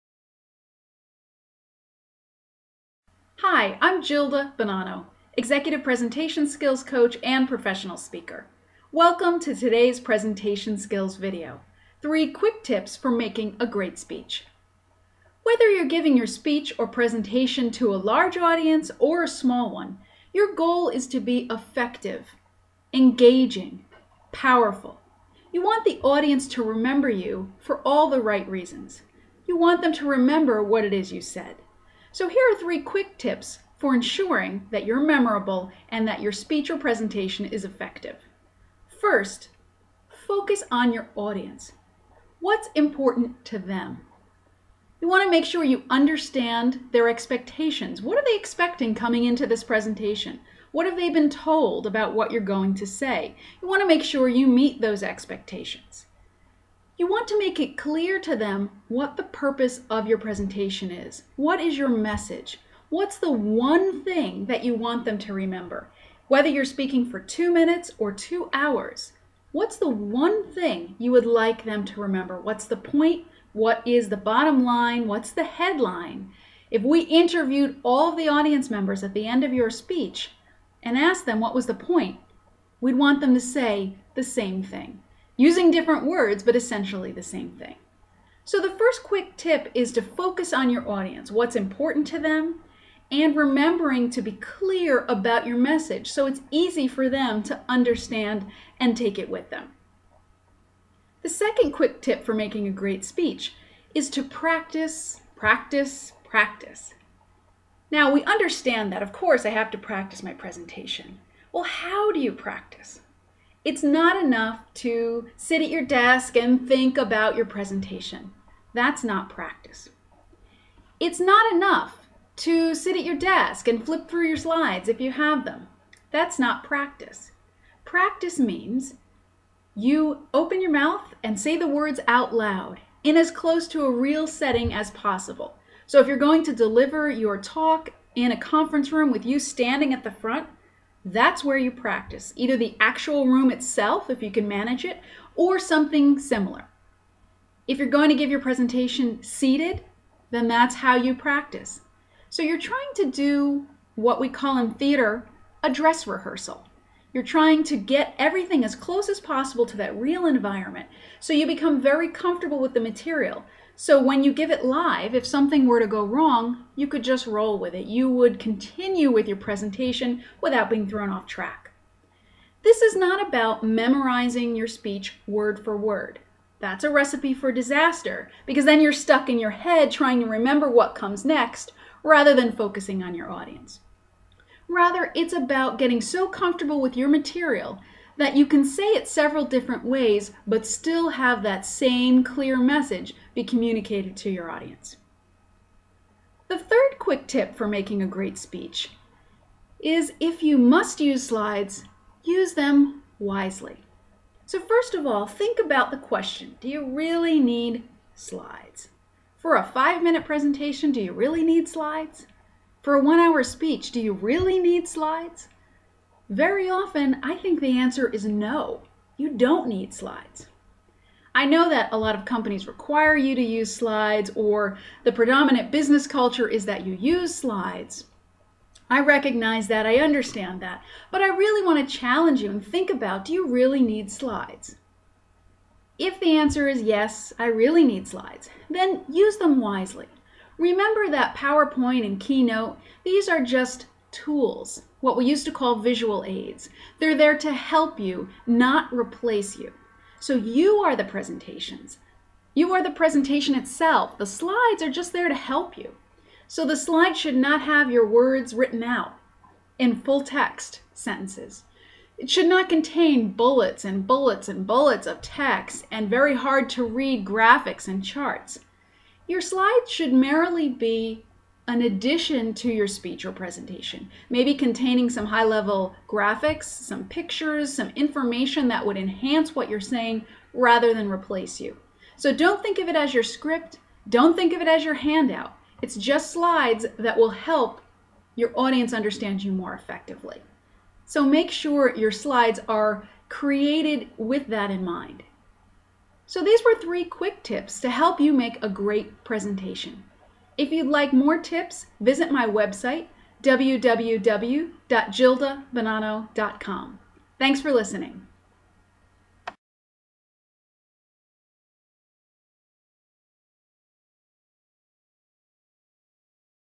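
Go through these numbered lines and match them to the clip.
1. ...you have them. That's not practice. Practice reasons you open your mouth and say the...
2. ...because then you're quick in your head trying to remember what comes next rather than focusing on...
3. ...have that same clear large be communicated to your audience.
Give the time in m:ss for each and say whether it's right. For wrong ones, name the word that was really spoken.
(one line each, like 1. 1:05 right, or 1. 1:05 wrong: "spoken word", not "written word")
1. 2:04 wrong: "means", not "reasons"
2. 2:58 wrong: "stuck", not "quick"
3. 3:11 wrong: "message", not "large".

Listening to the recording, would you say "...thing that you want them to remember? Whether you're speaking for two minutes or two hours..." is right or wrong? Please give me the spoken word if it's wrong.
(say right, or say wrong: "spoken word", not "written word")
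right.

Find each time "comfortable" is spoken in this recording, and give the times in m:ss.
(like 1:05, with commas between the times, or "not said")
2:42, 3:06.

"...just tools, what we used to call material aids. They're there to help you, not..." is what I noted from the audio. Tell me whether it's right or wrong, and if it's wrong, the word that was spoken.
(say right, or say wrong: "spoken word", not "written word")
wrong: "visual", not "material".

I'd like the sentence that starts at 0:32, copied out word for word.
So here are three quick tips for ensuring that you're memorable and that your speech or presentation is effective.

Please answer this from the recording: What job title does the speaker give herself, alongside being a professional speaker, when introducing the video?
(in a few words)
Executive Presentation Skills Coach.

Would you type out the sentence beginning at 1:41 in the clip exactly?
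The second quick tip for making a great speech is to practice, practice, practice.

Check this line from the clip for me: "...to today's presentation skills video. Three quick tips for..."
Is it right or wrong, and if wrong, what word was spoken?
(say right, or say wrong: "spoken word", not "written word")
right.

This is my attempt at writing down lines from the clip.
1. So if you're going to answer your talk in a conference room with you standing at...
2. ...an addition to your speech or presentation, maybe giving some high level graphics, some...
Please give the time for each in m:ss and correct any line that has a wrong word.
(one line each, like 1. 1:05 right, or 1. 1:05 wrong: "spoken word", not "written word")
1. 2:15 wrong: "deliver", not "answer"
2. 4:31 wrong: "containing", not "giving".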